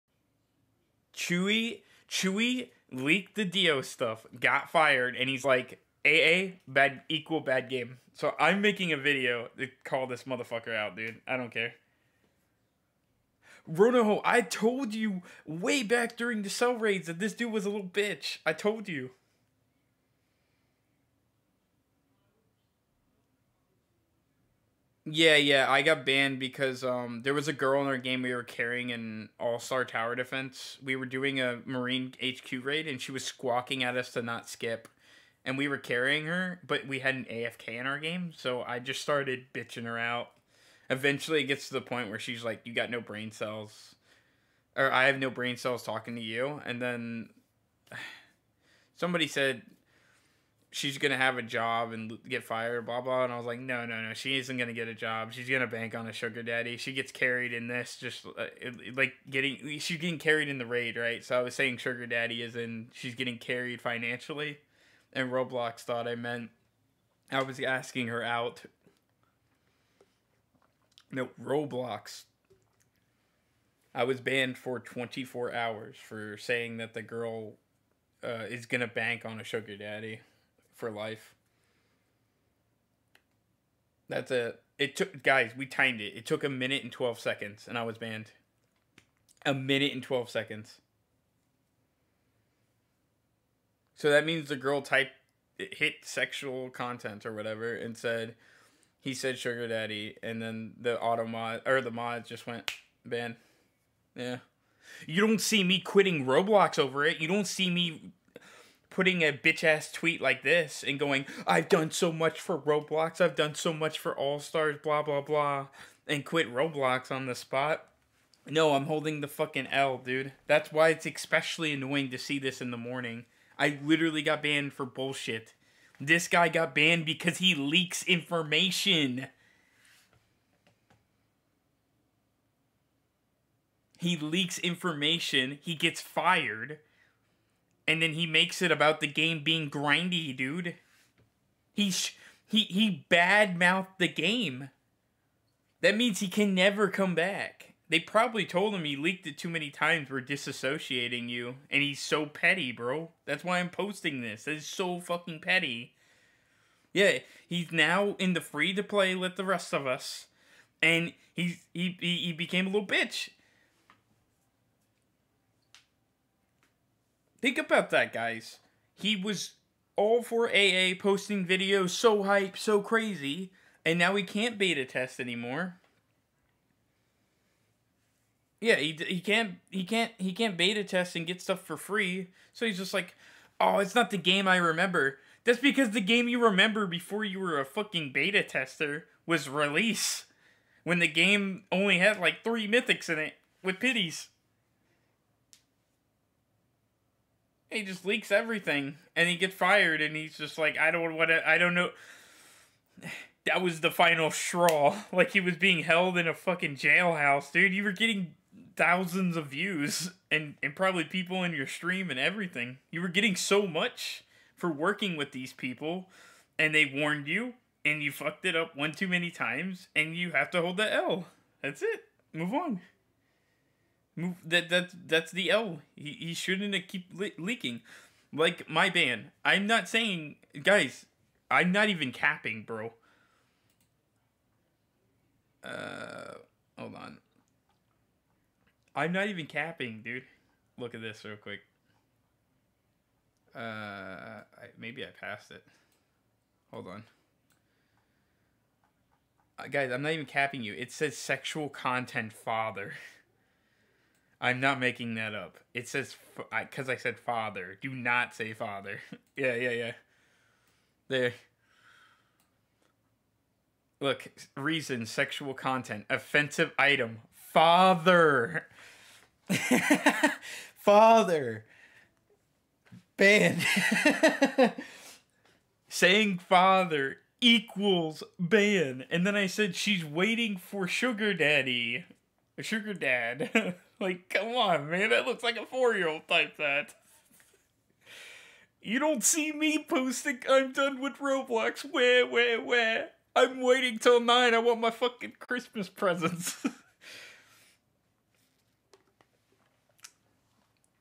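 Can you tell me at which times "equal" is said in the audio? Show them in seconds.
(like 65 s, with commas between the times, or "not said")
7 s, 277 s.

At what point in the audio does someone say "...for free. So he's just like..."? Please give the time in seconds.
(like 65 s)
181 s.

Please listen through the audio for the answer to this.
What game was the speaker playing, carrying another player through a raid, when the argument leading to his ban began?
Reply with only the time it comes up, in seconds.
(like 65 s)
29 s.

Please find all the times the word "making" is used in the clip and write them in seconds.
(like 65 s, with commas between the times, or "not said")
8 s, 254 s.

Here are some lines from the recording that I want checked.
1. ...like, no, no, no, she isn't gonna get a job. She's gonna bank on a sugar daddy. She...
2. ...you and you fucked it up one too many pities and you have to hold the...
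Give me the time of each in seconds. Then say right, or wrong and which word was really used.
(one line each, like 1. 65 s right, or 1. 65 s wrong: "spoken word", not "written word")
1. 53 s right
2. 217 s wrong: "times", not "pities".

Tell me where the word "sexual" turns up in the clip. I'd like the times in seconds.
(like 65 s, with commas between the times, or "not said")
96 s, 251 s, 265 s.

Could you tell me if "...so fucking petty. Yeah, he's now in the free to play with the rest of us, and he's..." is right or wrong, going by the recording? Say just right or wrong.
right.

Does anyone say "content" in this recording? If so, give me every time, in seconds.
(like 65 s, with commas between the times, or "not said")
96 s, 251 s, 265 s.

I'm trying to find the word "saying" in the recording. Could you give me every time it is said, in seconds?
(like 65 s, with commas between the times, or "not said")
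61 s, 76 s, 229 s, 275 s.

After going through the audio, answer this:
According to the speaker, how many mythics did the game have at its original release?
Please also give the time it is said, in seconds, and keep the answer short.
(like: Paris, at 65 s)
3, at 192 s.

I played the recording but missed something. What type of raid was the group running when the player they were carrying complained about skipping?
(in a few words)
Marine HQ raid.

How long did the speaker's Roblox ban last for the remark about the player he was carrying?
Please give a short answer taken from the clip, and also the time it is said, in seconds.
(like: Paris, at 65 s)
24 hours, at 74 s.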